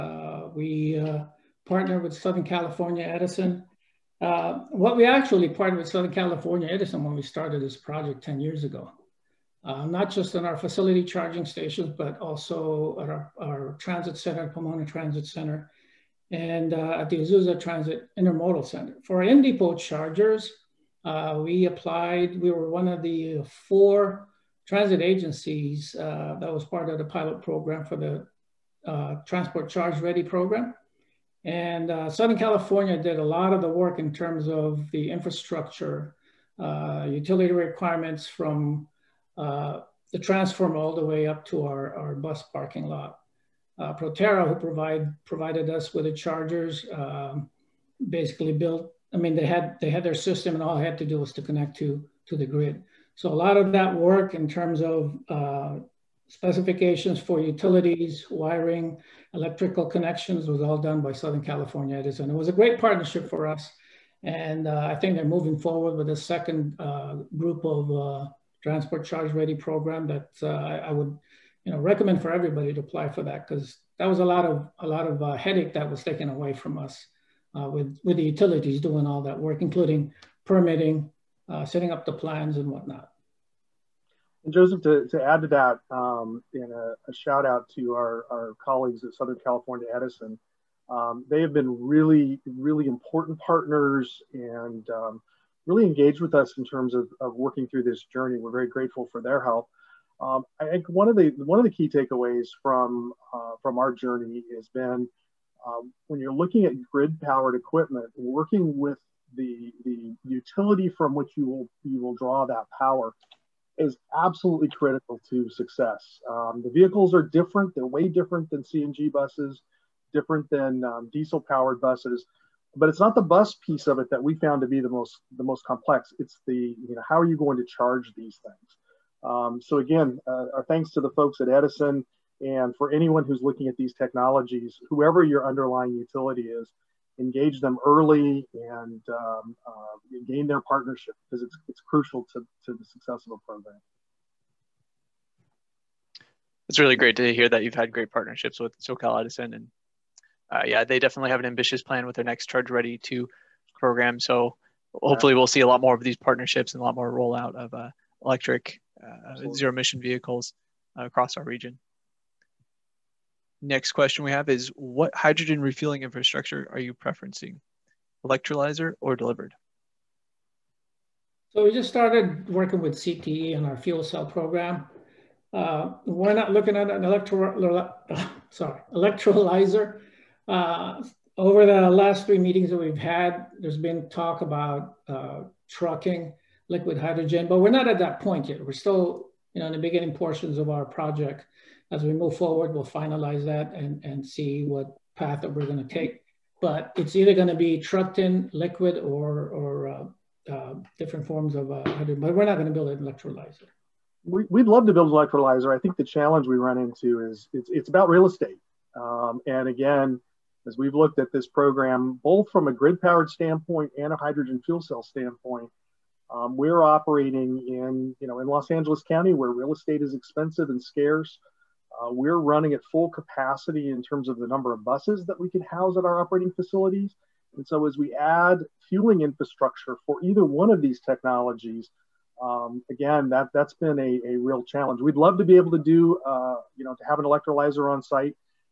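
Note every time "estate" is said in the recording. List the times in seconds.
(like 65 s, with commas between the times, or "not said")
208 s, 219 s.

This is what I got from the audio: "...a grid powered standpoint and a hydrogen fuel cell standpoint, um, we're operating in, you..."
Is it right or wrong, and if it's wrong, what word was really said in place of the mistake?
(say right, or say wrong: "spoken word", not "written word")
right.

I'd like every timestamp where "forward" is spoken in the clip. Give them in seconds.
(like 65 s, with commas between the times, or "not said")
65 s, 192 s.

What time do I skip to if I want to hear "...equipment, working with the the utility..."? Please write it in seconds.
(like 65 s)
107 s.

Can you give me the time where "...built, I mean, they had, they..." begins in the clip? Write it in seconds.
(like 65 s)
48 s.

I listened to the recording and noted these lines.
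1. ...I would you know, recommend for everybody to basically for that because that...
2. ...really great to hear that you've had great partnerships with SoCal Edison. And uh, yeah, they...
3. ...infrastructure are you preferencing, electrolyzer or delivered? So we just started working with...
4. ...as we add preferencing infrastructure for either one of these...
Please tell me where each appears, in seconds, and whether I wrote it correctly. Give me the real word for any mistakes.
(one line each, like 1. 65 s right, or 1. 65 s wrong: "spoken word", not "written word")
1. 70 s wrong: "apply", not "basically"
2. 146 s right
3. 166 s right
4. 227 s wrong: "fueling", not "preferencing".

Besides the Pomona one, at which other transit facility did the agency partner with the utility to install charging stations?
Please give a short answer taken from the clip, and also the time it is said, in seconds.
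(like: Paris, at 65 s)
Azusa Transit Intermodal Center, at 17 s.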